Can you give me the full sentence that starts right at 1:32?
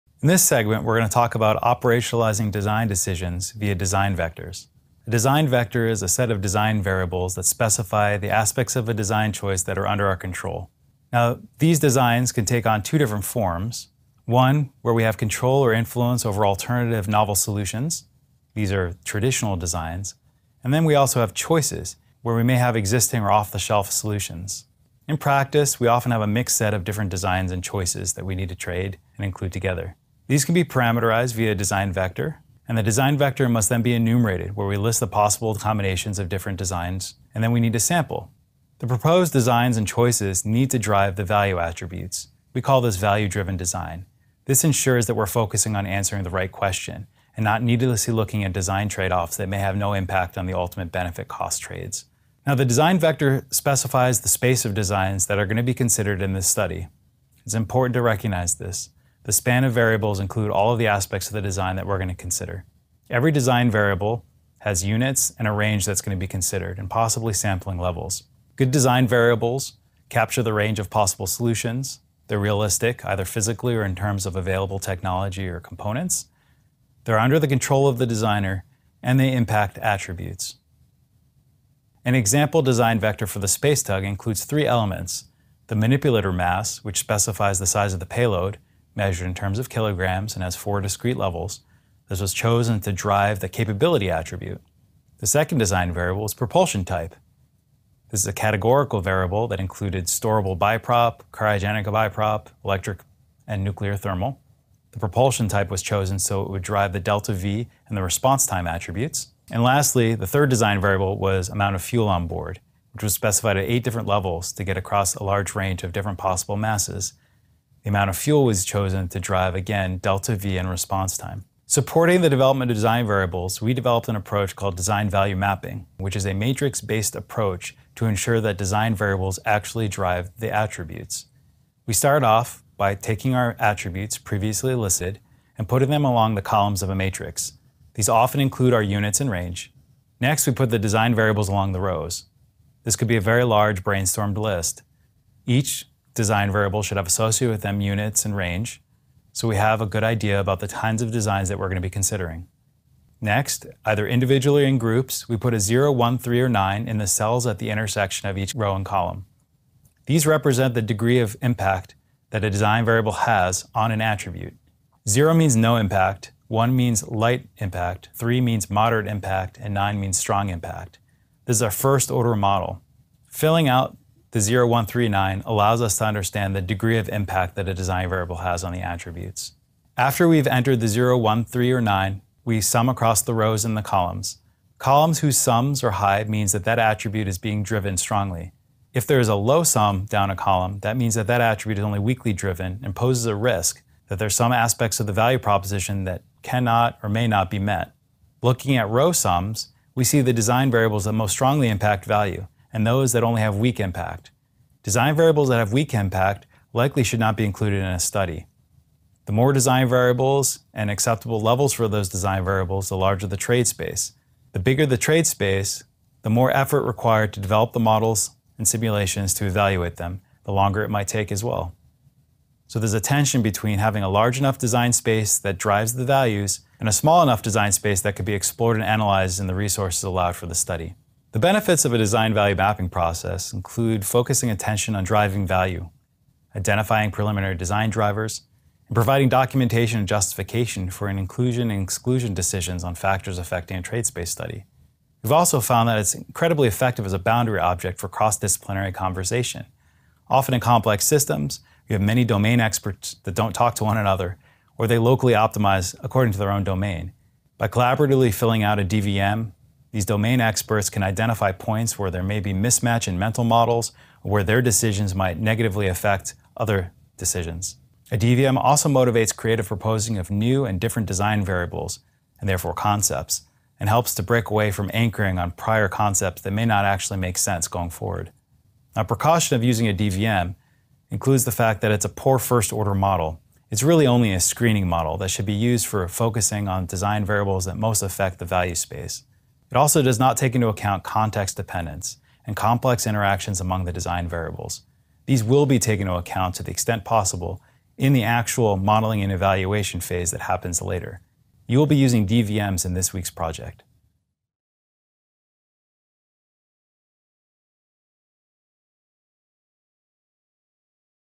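This was chosen to drive the capability attribute.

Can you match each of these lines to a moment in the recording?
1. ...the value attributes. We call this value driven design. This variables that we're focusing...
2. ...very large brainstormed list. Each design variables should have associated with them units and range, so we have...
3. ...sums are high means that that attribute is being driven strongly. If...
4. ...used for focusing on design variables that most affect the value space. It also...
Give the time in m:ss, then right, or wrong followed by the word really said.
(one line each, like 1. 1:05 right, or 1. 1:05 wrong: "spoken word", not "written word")
1. 0:41 wrong: "ensures", not "variables"
2. 2:23 right
3. 3:05 right
4. 4:45 right.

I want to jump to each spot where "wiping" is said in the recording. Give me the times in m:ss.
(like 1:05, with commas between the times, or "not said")
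not said.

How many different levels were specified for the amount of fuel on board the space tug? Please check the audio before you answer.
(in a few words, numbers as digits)
8.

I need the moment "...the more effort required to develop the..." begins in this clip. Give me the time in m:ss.
3:36.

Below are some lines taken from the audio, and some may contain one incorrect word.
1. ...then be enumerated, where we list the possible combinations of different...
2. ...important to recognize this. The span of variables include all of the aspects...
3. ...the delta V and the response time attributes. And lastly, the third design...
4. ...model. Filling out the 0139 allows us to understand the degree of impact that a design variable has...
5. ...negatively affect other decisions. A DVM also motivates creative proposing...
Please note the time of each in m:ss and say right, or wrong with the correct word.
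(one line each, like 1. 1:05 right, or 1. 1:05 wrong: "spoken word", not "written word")
1. 0:33 right
2. 0:57 right
3. 1:46 right
4. 2:52 right
5. 4:25 right.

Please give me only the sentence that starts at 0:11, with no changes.
Now, these designs can take on two different forms.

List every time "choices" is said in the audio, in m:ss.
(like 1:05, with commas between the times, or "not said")
0:09, 0:21, 0:27, 0:39.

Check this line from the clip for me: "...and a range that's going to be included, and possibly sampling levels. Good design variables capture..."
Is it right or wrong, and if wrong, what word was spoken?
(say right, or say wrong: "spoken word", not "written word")
wrong: "considered", not "included".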